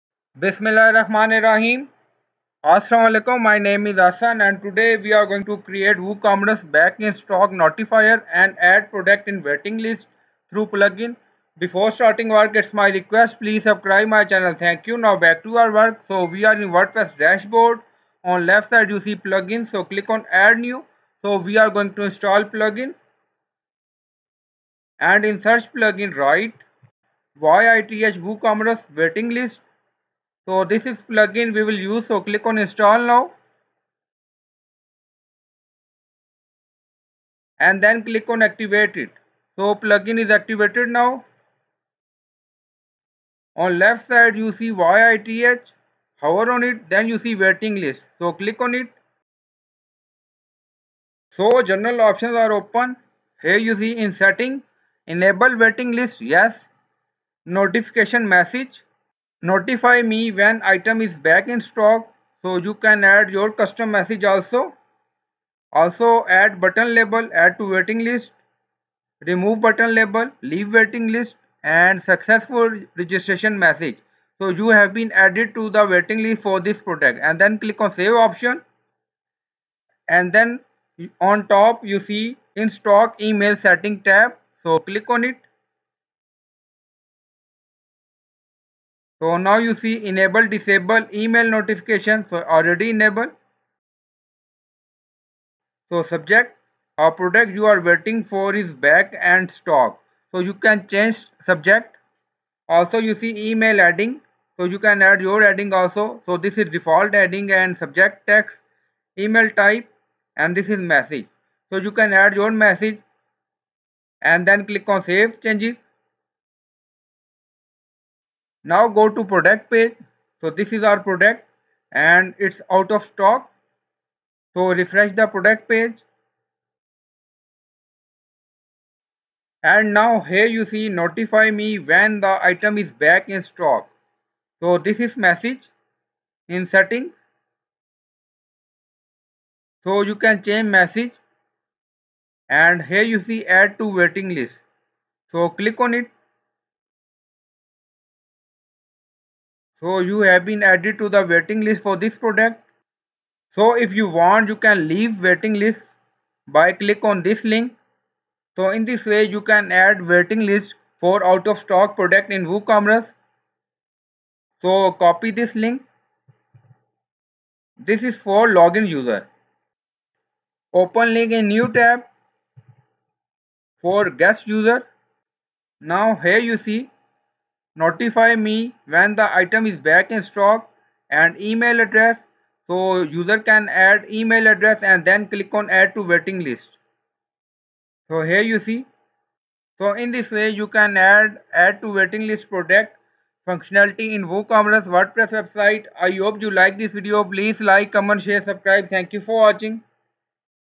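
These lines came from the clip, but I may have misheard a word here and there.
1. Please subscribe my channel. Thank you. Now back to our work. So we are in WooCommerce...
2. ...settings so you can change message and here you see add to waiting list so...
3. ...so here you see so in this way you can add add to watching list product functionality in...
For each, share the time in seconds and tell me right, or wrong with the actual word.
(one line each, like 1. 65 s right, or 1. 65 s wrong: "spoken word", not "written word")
1. 13 s wrong: "WordPress", not "WooCommerce"
2. 136 s right
3. 188 s wrong: "waiting", not "watching".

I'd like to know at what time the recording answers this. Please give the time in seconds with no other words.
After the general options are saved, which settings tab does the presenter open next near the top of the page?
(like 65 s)
82 s.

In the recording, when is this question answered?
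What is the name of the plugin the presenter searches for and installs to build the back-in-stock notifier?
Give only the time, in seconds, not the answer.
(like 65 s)
27 s.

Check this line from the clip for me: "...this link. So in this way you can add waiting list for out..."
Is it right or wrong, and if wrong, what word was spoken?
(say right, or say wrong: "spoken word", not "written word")
right.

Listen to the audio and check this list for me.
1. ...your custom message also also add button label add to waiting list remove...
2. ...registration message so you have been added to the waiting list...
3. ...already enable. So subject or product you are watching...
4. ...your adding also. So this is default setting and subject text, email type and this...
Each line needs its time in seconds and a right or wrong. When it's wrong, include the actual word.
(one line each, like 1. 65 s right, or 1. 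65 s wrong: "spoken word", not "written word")
1. 63 s right
2. 72 s right
3. 92 s wrong: "waiting", not "watching"
4. 105 s wrong: "adding", not "setting".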